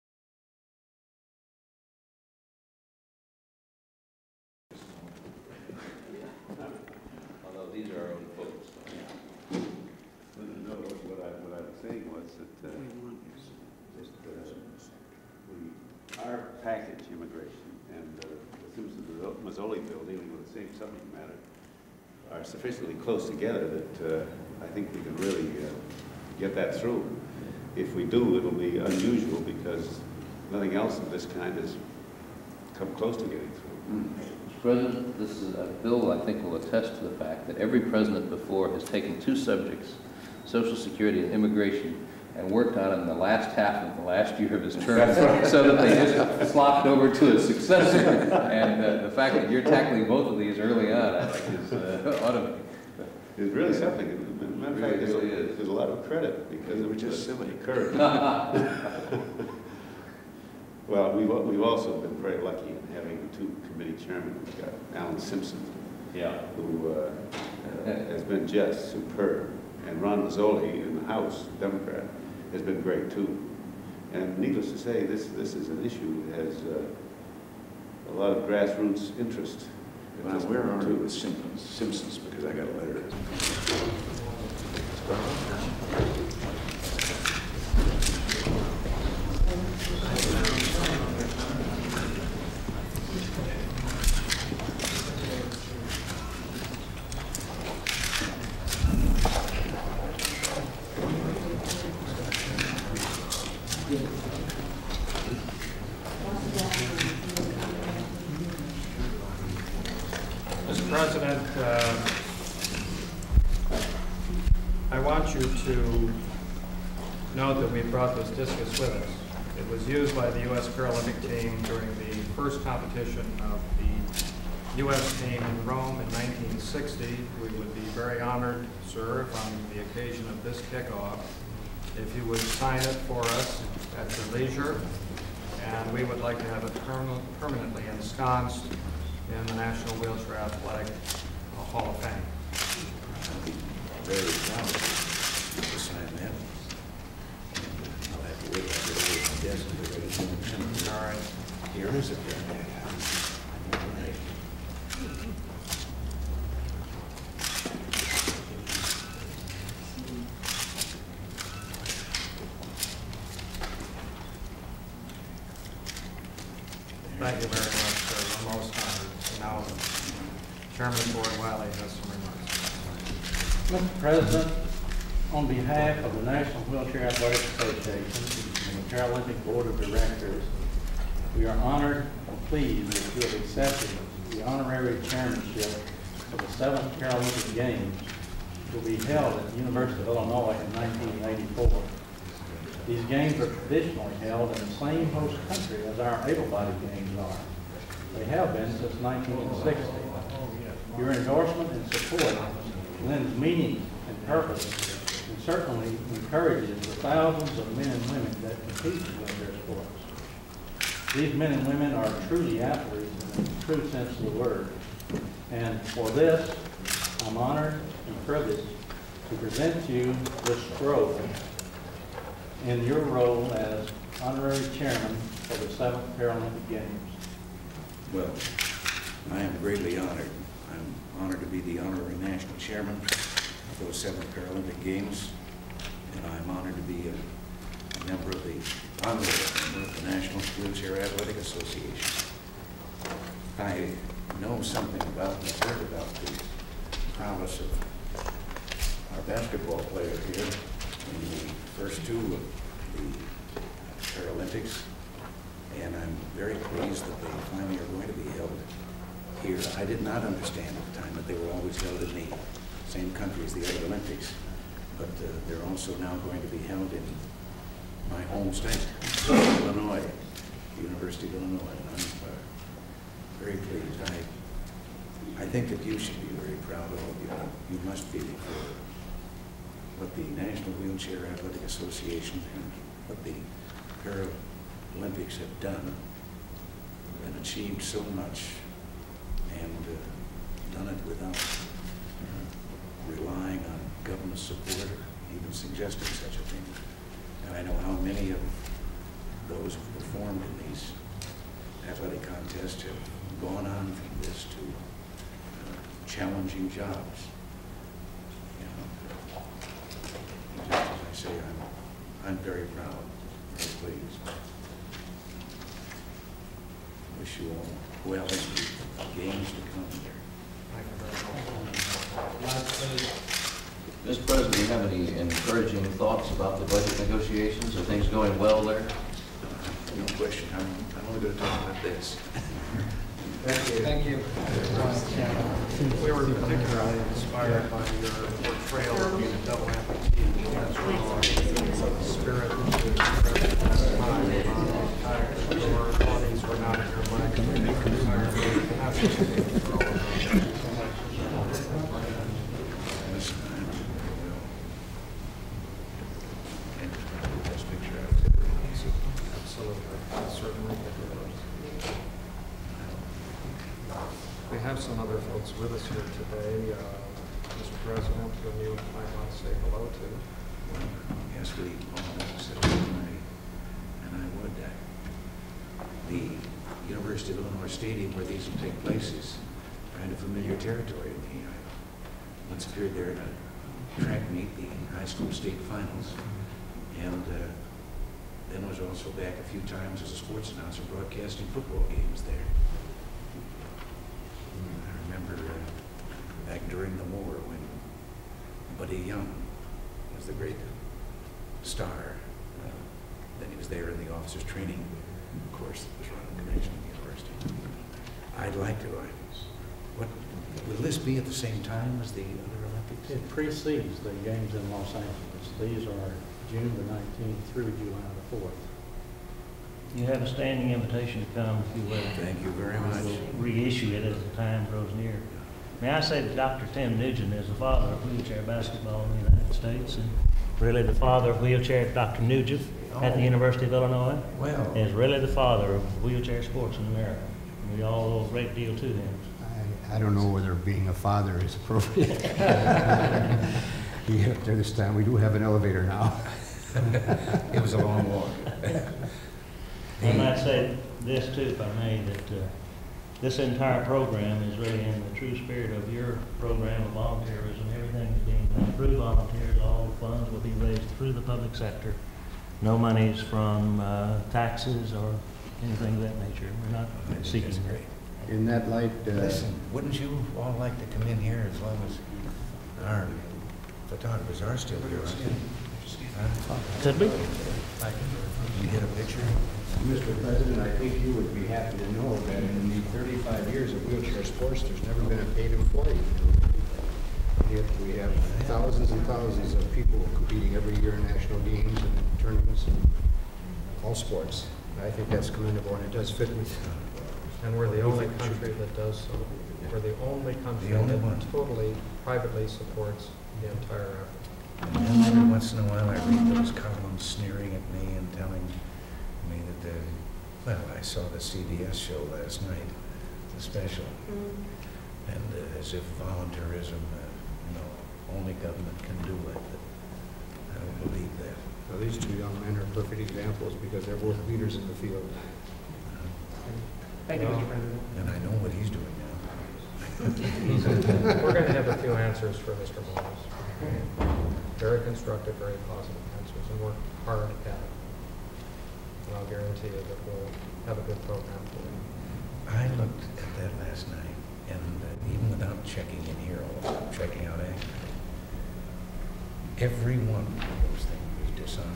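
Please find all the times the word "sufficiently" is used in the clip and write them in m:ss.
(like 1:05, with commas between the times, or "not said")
0:22.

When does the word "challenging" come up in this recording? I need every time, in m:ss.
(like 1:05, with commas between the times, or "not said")
5:06.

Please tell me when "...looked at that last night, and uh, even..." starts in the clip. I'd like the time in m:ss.
9:02.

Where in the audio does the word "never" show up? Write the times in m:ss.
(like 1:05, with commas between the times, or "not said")
8:04.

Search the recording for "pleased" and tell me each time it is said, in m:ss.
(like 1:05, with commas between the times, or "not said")
3:02, 4:16, 4:33, 5:13.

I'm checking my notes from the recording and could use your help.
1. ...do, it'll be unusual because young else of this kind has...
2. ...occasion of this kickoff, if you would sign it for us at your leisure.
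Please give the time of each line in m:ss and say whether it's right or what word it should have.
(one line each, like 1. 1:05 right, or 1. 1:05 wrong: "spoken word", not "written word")
1. 0:28 wrong: "nothing", not "young"
2. 2:09 right.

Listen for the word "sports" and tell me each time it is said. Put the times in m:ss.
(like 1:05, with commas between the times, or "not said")
3:29, 6:30, 7:16, 8:13.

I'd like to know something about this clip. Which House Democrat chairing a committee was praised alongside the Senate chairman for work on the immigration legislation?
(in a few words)
Ron Mazzoli.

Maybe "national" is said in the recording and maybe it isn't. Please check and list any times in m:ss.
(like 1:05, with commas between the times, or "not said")
2:19, 2:56, 3:52, 4:00, 4:40, 8:11.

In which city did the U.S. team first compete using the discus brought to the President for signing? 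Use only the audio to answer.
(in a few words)
Rome.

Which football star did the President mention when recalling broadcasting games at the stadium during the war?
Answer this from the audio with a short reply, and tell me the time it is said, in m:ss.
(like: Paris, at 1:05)
Buddy Young, at 6:38.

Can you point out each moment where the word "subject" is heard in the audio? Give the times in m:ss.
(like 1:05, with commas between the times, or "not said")
0:20, 0:39.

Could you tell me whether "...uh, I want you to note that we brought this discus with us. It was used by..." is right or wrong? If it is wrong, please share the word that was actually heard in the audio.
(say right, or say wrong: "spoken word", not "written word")
right.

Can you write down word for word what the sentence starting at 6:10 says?
Well, yes, we all said tonight, and I would.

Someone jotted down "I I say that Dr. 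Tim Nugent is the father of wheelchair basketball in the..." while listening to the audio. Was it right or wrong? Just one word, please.
right.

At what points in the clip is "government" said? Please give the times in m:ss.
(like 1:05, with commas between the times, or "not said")
4:54, 8:38.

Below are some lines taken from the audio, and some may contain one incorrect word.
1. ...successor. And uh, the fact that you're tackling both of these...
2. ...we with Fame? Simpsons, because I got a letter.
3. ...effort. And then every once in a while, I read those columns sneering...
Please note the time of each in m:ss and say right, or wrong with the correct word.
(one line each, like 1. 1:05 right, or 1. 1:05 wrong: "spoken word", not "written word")
1. 0:47 right
2. 1:20 wrong: "Simpsons", not "Fame"
3. 8:24 right.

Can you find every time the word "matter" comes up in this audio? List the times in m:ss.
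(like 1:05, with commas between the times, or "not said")
0:21, 0:54.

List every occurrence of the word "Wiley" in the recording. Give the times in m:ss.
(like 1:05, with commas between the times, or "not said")
2:51.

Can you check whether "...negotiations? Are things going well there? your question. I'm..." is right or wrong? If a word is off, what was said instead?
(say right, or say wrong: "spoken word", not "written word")
right.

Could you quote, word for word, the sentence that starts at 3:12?
These games are traditionally held in the same host country as our able-bodied games are.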